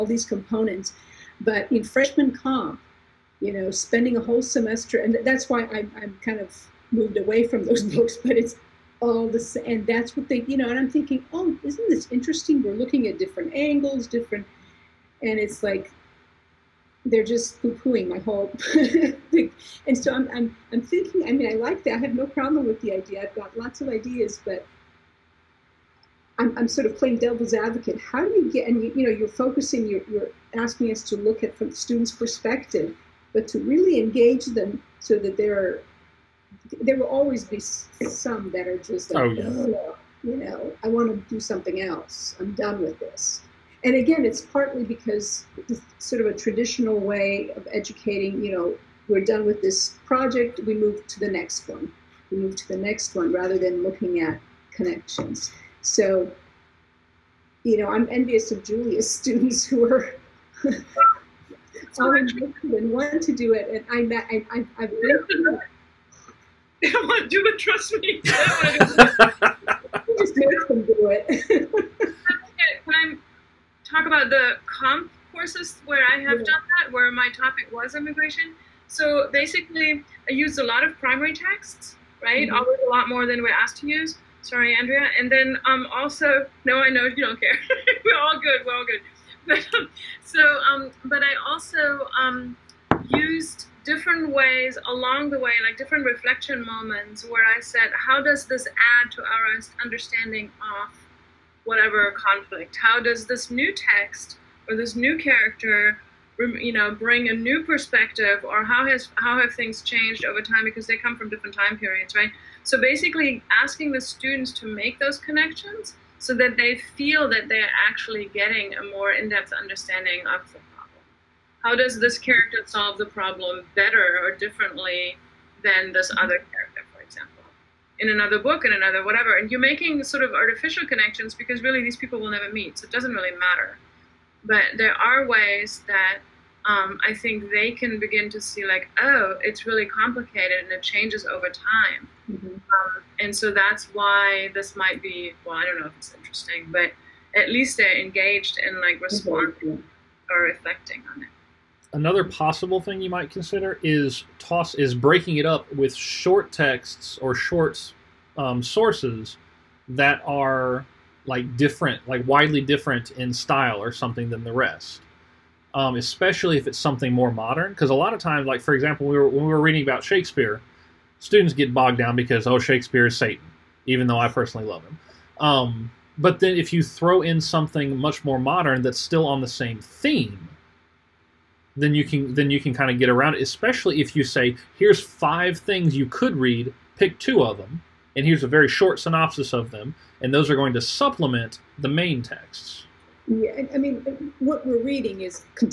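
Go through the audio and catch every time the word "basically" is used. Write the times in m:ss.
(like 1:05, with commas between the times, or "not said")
1:19, 1:52.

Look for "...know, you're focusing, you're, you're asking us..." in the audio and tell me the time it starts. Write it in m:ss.
0:29.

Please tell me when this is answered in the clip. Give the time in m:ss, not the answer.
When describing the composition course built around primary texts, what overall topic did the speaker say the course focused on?
1:17.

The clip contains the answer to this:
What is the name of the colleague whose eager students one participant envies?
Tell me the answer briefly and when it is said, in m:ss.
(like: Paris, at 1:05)
Julia, at 0:58.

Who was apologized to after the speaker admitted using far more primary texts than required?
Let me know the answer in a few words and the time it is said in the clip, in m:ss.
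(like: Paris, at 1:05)
Andrea, at 1:24.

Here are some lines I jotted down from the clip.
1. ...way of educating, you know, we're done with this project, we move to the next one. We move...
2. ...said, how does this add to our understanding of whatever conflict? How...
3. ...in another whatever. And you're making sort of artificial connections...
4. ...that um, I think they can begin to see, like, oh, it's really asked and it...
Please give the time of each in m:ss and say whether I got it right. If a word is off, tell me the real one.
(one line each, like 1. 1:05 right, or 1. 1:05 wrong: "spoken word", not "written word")
1. 0:46 right
2. 1:37 right
3. 2:08 right
4. 2:15 wrong: "complicated", not "asked".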